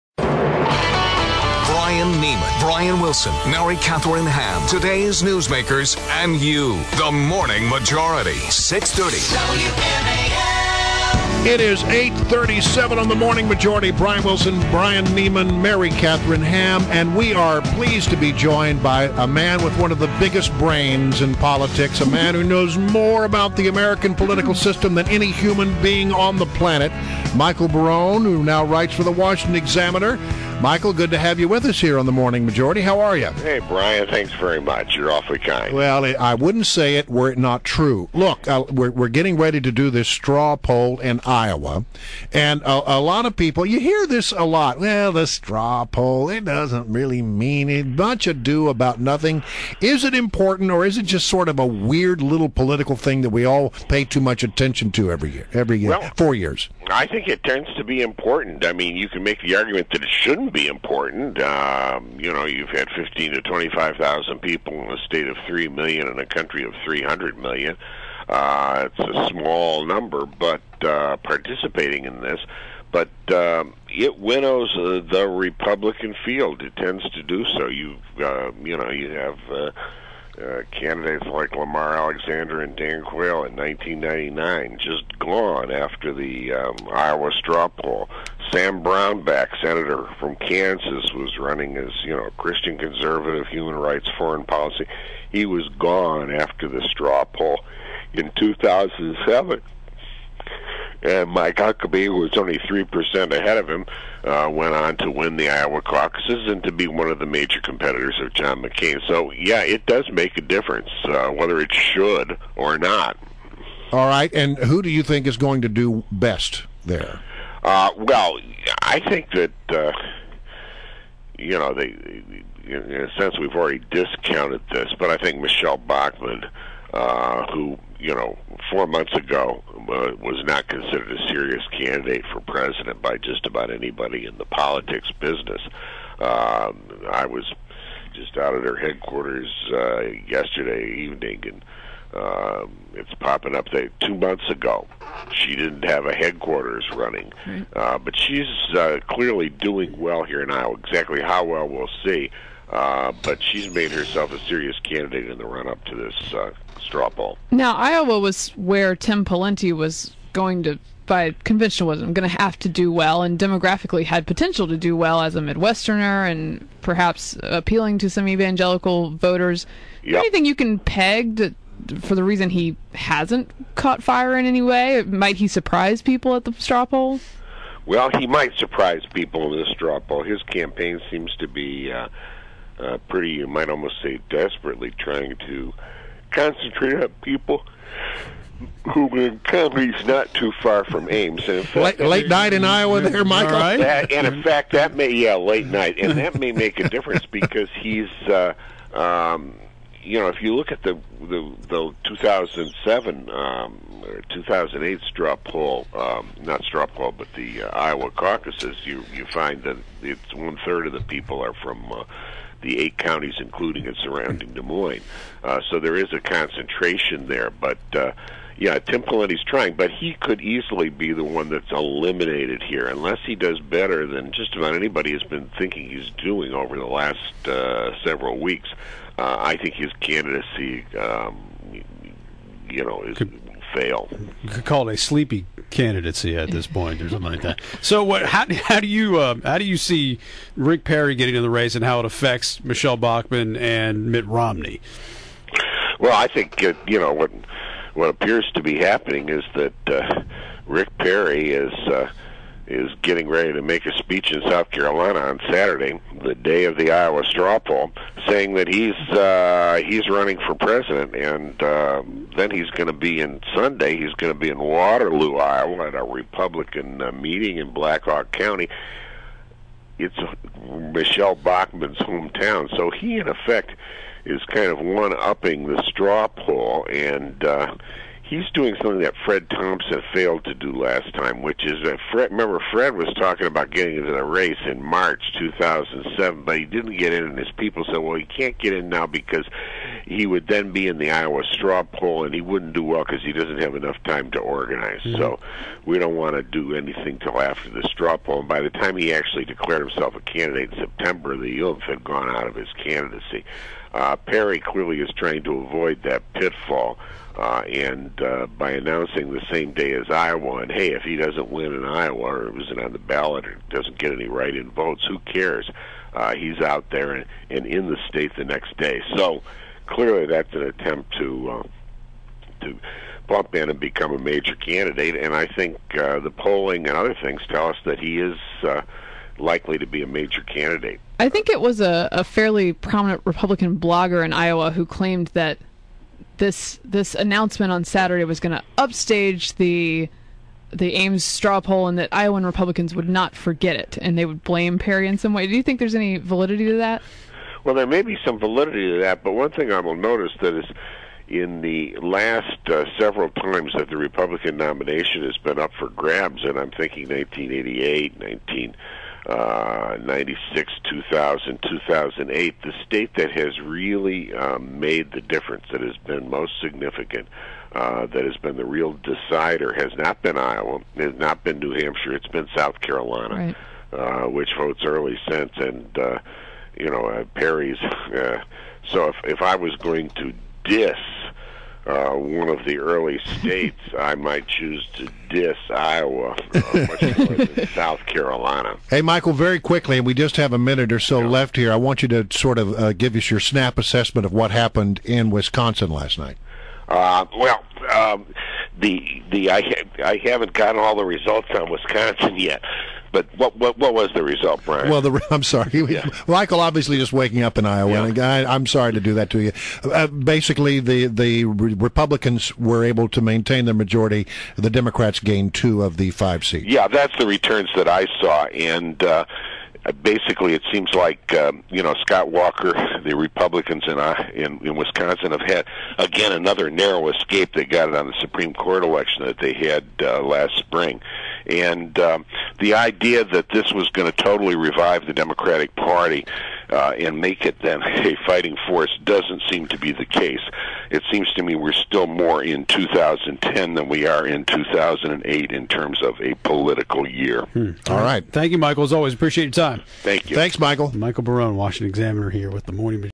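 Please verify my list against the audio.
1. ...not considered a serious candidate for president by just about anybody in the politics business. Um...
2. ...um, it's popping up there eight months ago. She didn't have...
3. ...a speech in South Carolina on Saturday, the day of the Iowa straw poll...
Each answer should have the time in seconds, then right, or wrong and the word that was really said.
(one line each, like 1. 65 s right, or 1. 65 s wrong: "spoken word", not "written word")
1. 130 s right
2. 142 s wrong: "two", not "eight"
3. 253 s right.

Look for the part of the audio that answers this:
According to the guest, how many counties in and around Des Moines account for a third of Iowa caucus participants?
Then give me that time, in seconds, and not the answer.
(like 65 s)
212 s.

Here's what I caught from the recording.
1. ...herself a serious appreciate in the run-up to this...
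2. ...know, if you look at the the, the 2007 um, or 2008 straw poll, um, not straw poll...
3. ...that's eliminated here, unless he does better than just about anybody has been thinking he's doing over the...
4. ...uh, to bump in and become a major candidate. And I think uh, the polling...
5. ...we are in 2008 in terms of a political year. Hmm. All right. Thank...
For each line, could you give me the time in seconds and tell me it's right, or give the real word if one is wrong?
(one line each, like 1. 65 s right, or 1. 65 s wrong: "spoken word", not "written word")
1. 153 s wrong: "candidate", not "appreciate"
2. 200 s right
3. 221 s right
4. 321 s right
5. 443 s right.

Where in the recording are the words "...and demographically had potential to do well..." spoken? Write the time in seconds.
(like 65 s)
163 s.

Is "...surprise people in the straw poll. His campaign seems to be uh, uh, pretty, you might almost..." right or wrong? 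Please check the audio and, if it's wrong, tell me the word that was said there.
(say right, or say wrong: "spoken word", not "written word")
right.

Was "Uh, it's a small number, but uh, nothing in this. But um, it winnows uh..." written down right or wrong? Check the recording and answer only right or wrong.
wrong.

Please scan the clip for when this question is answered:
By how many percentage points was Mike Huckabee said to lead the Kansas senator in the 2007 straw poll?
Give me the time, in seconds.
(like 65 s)
102 s.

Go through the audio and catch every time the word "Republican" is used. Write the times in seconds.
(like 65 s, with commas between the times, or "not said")
75 s, 266 s, 333 s, 342 s, 353 s, 411 s, 423 s.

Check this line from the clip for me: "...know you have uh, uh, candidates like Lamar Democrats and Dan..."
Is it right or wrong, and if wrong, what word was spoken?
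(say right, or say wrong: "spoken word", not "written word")
wrong: "Alexander", not "Democrats".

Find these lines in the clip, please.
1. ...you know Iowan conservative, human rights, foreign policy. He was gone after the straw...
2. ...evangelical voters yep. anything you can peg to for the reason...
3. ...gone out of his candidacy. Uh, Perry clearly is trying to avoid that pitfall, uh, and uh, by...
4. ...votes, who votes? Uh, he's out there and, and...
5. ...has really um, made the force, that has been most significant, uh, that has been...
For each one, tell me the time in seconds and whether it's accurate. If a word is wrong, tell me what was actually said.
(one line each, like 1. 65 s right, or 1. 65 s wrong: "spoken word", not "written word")
1. 92 s wrong: "Christian", not "Iowan"
2. 168 s right
3. 302 s right
4. 314 s wrong: "cares", not "votes"
5. 363 s wrong: "difference", not "force".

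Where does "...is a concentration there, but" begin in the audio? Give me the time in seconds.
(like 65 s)
215 s.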